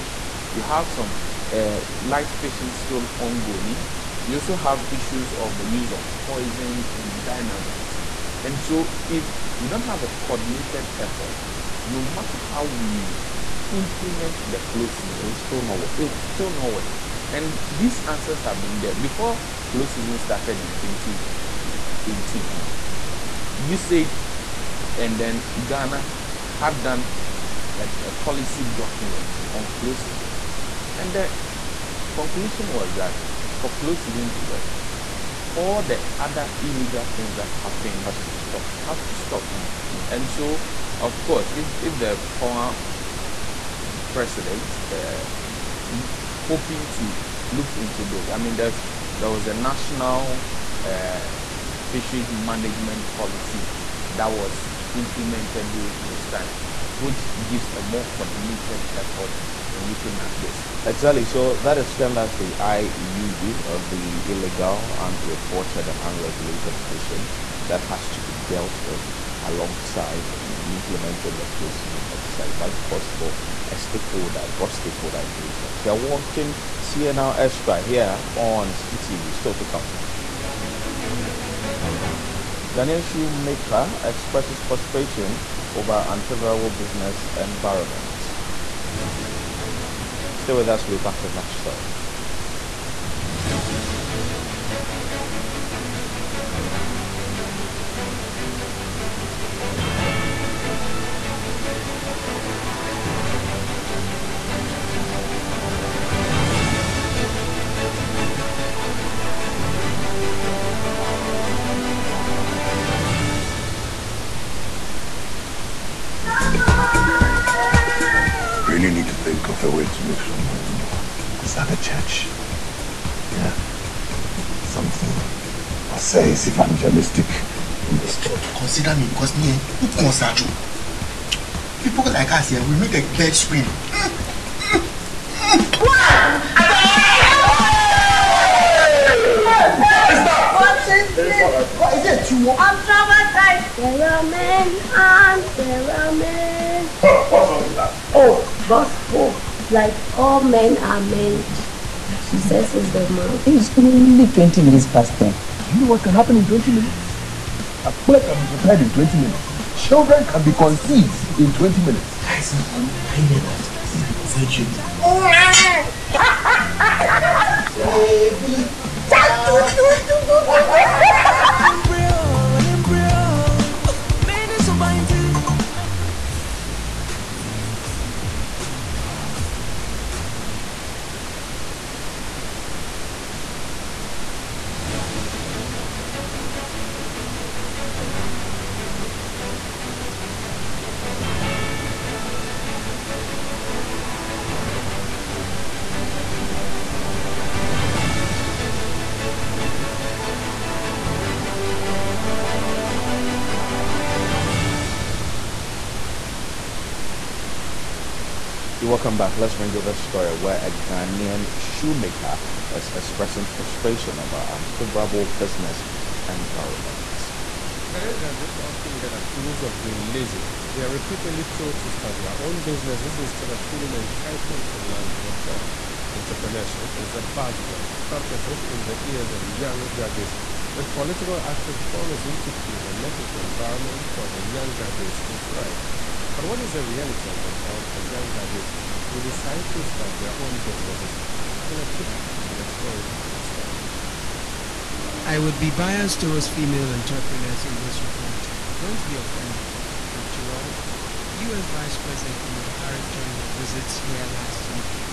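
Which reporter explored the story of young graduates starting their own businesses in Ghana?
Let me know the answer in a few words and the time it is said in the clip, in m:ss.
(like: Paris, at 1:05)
Caleb Kudah, at 4:01.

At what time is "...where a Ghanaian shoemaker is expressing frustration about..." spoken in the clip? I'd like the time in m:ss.
3:30.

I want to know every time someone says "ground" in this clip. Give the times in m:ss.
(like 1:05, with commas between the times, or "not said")
3:57.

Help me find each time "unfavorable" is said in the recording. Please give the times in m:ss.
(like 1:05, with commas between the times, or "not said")
1:26, 3:34.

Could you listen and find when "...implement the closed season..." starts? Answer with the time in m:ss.
0:13.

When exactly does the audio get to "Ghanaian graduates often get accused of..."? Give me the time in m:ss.
3:37.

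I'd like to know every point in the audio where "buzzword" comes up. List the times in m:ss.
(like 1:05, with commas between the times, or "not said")
3:47.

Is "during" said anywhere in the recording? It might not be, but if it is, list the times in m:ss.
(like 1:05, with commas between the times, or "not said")
0:55, 4:13.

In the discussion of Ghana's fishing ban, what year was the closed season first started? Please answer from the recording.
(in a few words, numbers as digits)
2018.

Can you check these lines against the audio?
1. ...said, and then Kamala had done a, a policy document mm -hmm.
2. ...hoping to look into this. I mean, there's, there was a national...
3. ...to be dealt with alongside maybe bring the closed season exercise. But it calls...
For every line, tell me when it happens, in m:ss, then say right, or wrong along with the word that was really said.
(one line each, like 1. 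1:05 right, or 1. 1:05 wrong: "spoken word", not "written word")
1. 0:23 wrong: "Ghana", not "Kamala"
2. 0:46 right
3. 1:08 wrong: "implementing", not "bring".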